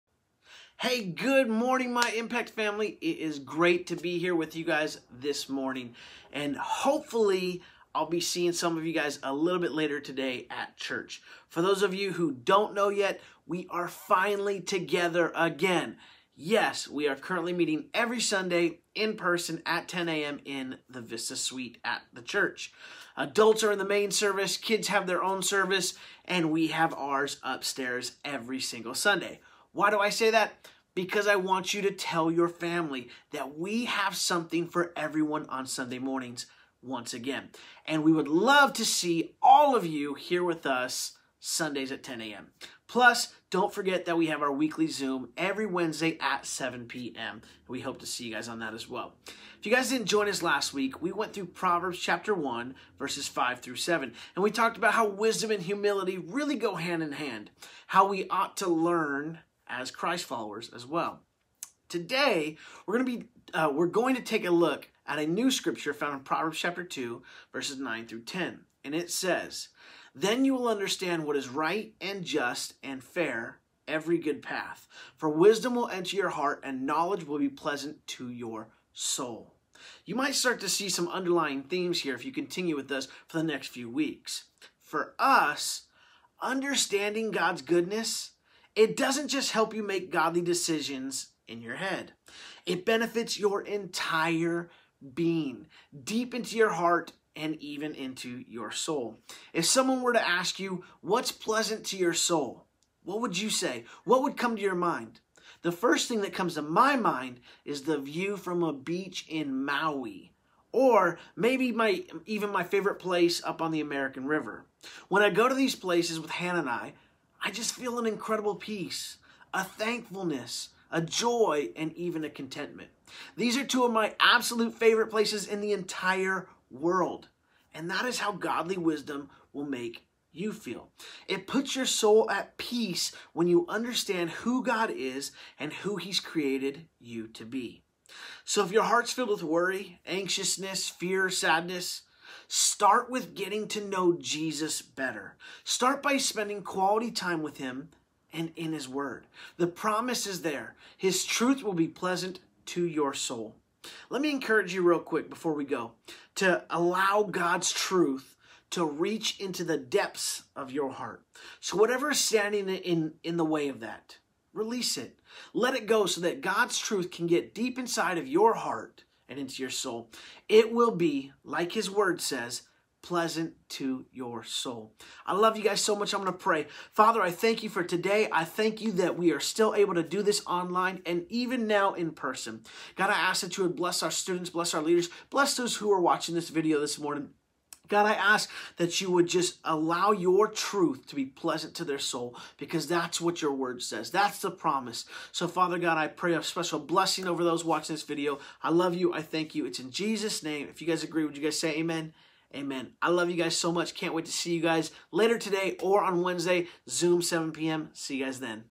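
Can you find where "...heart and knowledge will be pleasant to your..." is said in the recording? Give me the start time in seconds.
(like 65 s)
76 s.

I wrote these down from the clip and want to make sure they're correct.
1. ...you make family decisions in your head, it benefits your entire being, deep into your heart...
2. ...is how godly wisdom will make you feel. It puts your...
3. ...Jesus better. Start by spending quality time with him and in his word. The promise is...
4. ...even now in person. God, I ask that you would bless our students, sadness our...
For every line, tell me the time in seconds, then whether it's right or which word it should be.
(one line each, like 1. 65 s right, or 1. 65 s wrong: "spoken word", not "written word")
1. 89 s wrong: "godly", not "family"
2. 128 s right
3. 144 s right
4. 181 s wrong: "bless", not "sadness".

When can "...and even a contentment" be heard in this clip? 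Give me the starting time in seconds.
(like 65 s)
121 s.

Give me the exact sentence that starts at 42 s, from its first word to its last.
Plus, don't forget that we have our weekly Zoom every Wednesday at 7 p.m.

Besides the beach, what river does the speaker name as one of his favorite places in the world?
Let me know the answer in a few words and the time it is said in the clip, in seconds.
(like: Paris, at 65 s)
American River, at 113 s.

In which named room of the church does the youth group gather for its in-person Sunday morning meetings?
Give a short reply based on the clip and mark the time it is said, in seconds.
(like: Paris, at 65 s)
Vista Suite, at 21 s.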